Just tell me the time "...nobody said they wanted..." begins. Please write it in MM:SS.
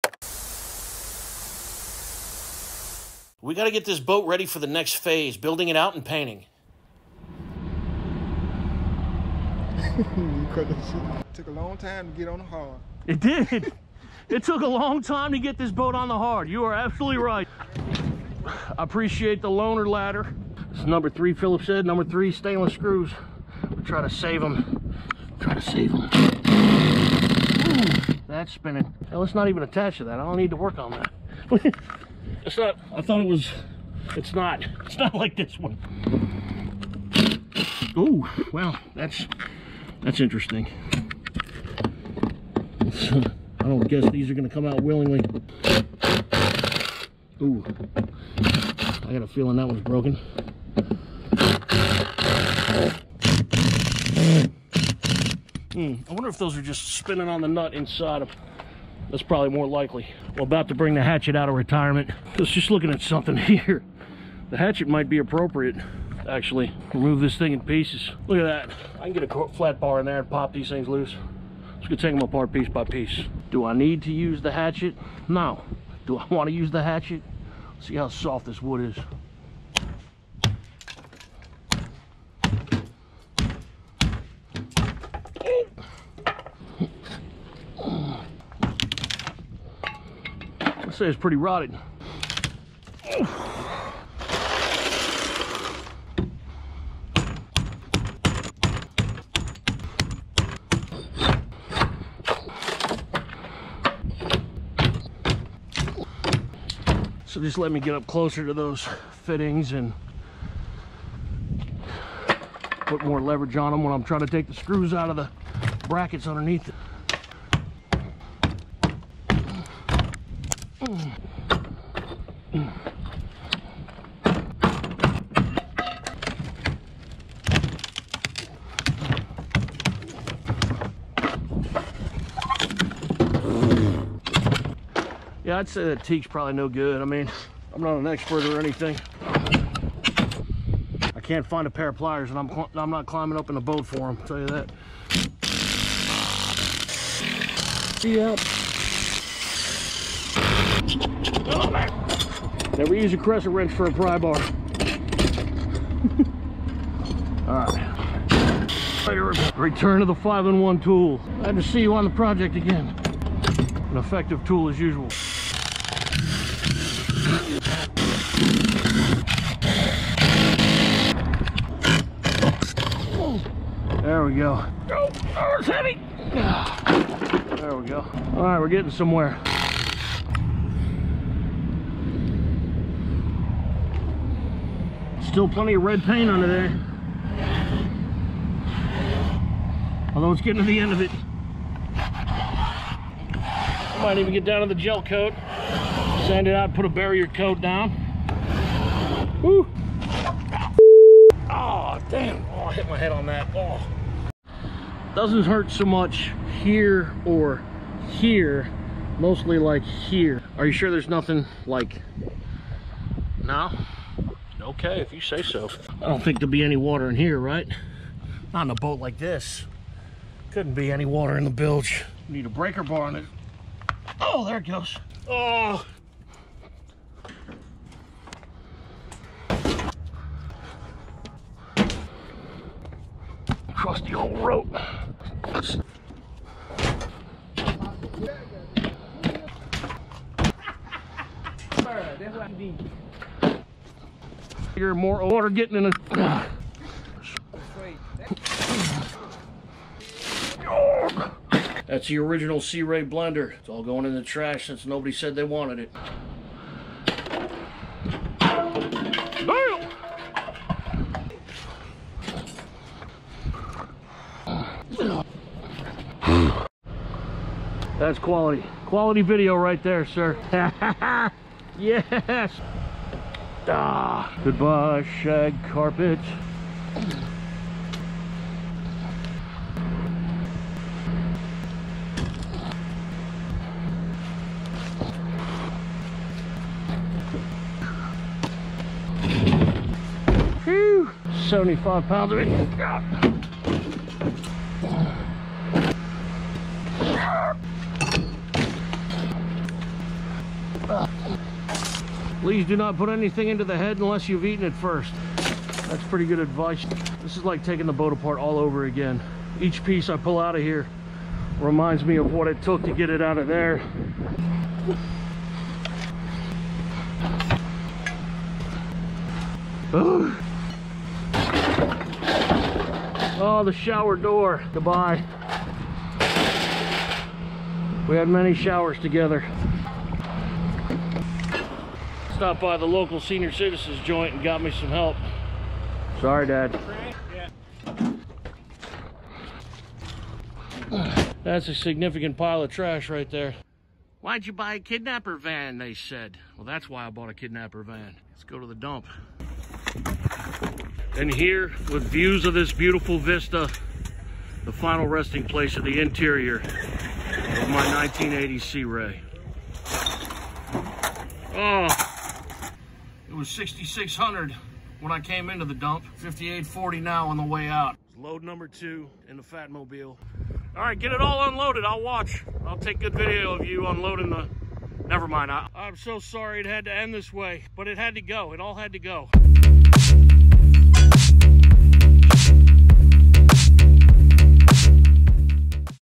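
04:14.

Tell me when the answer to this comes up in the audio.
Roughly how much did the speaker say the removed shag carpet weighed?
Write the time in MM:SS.
04:51.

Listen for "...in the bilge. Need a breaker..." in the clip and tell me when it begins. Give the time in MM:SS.
03:41.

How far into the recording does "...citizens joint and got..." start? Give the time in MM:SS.
05:33.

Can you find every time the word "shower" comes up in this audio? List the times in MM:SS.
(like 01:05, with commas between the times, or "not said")
05:23, 05:28.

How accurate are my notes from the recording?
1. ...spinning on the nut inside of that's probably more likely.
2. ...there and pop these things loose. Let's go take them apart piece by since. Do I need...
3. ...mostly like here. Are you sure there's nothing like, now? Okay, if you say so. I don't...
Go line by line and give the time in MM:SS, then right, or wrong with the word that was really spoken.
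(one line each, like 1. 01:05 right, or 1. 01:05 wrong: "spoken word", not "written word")
1. 00:56 right
2. 01:10 wrong: "piece", not "since"
3. 03:29 right.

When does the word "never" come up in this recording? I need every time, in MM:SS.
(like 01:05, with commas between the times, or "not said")
02:32, 06:15.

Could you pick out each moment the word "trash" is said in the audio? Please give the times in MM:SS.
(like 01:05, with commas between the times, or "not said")
04:14, 05:42.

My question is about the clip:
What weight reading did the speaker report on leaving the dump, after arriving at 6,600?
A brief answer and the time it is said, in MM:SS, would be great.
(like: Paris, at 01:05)
5840, at 06:06.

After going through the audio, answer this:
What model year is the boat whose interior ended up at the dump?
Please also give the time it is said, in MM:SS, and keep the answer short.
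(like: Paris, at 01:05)
1980, at 05:57.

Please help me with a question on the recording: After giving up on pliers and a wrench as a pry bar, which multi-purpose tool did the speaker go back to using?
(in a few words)
5-in-1 tool.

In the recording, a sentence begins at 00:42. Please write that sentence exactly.
Uh, I don't guess these are gonna come out willingly.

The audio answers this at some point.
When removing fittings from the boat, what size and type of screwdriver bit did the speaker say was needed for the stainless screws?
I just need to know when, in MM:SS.
00:20.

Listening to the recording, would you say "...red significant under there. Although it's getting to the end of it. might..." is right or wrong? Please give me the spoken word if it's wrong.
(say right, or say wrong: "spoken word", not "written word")
wrong: "paint", not "significant".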